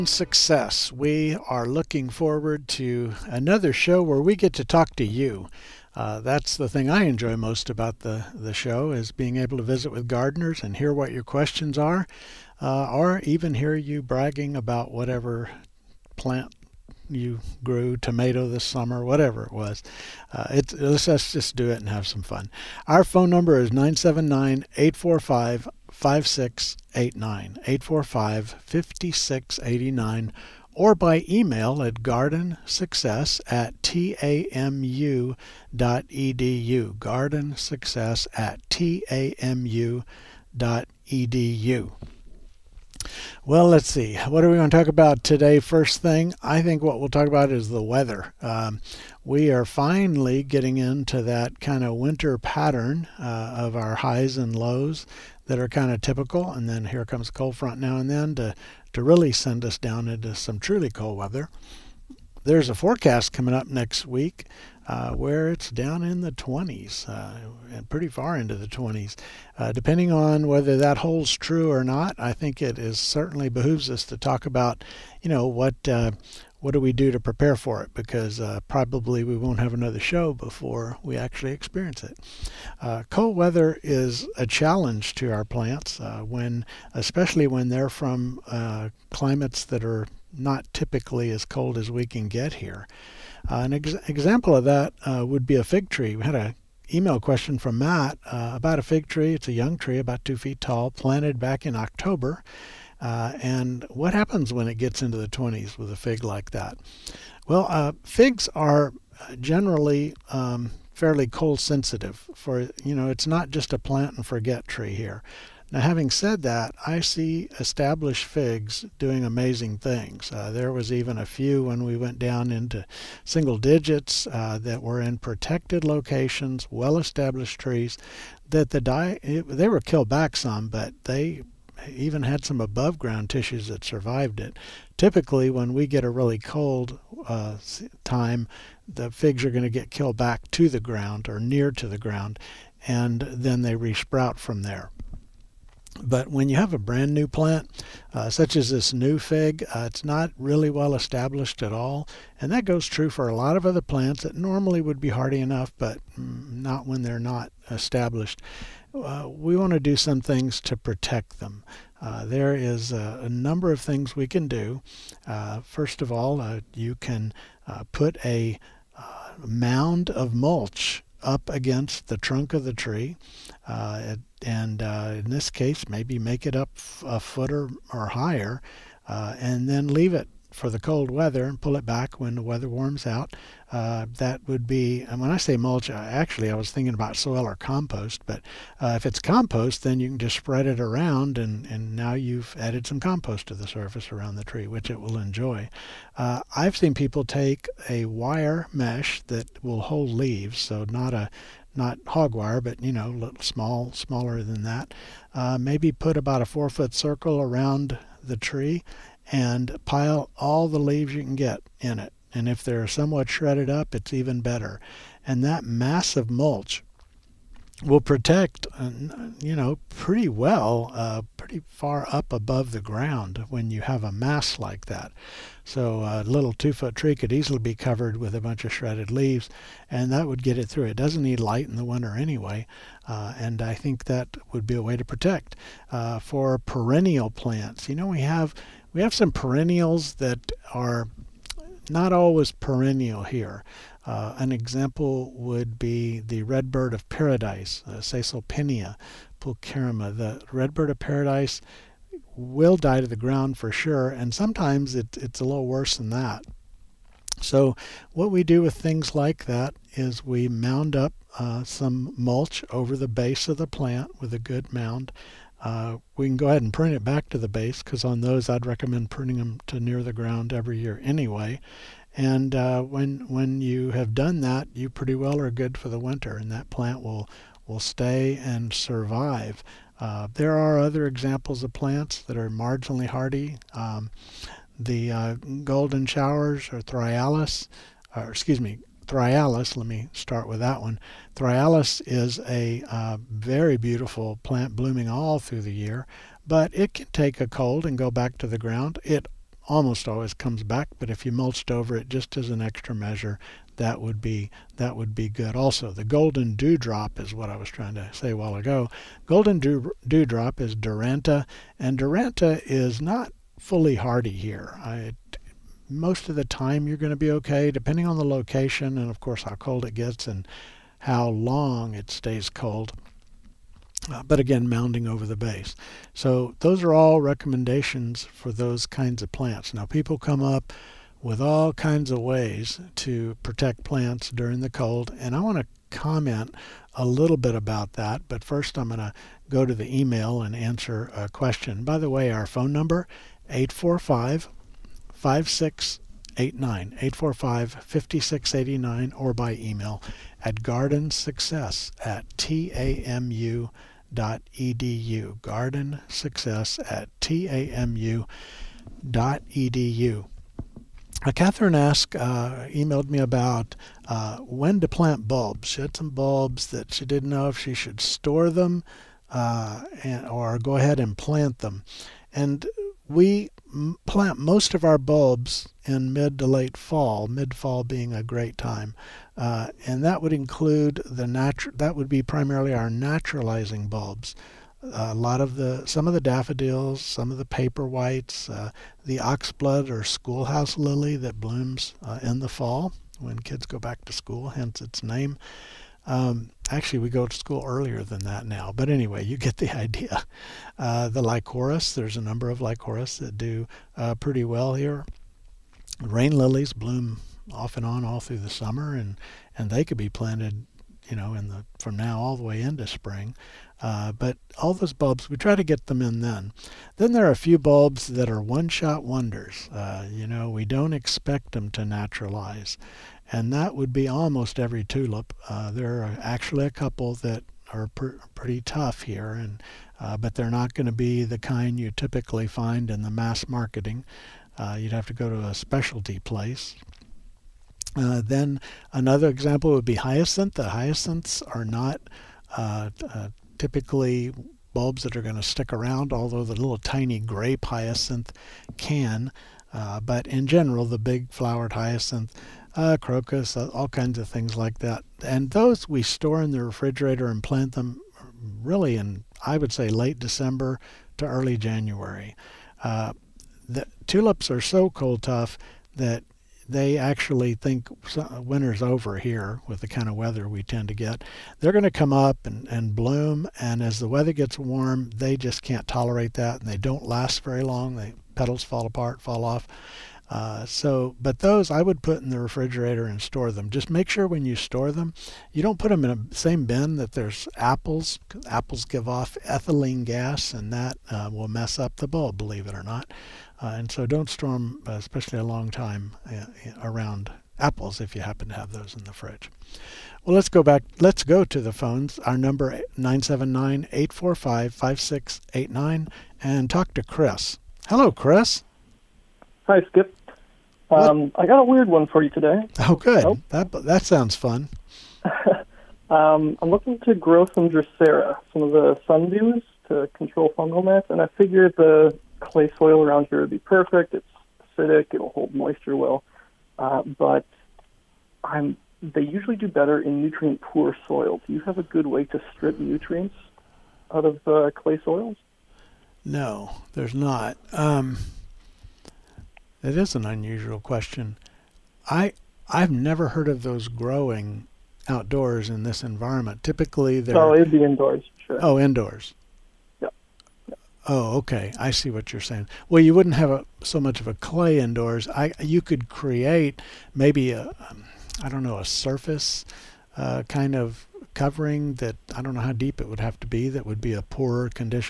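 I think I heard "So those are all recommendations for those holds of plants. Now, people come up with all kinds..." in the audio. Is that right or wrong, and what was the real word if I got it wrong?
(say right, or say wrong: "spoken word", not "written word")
wrong: "kinds", not "holds".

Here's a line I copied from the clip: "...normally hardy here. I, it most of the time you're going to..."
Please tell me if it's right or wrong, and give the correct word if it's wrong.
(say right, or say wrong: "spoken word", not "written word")
wrong: "fully", not "normally".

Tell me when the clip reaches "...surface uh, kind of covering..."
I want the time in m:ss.
9:18.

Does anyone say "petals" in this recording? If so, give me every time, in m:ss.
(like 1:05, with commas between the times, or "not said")
7:58.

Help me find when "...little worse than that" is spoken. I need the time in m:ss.
4:15.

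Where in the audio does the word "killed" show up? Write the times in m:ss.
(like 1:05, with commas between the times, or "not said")
2:09, 2:19.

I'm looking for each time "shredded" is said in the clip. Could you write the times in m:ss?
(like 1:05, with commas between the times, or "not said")
3:33, 3:48.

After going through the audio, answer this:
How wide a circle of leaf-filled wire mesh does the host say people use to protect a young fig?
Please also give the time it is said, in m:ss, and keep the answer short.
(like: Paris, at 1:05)
4 feet, at 3:26.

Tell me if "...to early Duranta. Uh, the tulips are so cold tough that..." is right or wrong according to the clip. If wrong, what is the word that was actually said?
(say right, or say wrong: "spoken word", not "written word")
wrong: "January", not "Duranta".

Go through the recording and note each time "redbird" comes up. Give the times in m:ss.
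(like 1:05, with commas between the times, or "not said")
4:06, 4:10.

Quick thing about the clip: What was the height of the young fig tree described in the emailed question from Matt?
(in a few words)
2 feet.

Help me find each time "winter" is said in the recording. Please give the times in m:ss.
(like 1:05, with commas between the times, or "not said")
0:51, 3:51, 4:36, 7:48.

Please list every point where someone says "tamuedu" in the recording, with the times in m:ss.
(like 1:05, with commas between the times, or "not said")
0:33, 0:38, 5:52, 5:57.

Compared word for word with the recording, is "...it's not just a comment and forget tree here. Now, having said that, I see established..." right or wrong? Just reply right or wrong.
wrong.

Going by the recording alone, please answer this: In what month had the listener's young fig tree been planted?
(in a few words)
October.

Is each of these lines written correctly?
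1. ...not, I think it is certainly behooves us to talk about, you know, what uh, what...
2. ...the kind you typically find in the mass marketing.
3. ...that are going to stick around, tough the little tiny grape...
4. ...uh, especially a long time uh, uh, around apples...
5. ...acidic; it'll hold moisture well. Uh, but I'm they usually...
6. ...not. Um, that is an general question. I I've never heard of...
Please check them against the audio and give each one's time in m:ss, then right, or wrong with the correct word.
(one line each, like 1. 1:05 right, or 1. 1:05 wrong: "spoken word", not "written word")
1. 1:11 right
2. 7:11 right
3. 7:25 wrong: "although", not "tough"
4. 8:14 right
5. 8:44 right
6. 8:57 wrong: "unusual", not "general".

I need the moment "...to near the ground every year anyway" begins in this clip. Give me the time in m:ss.
4:29.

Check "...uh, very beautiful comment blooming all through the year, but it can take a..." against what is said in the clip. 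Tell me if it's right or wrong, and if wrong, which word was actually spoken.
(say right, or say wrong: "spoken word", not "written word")
wrong: "plant", not "comment".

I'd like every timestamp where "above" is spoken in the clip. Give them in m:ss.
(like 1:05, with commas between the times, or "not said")
2:12, 3:42.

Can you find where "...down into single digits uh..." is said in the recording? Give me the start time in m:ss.
2:02.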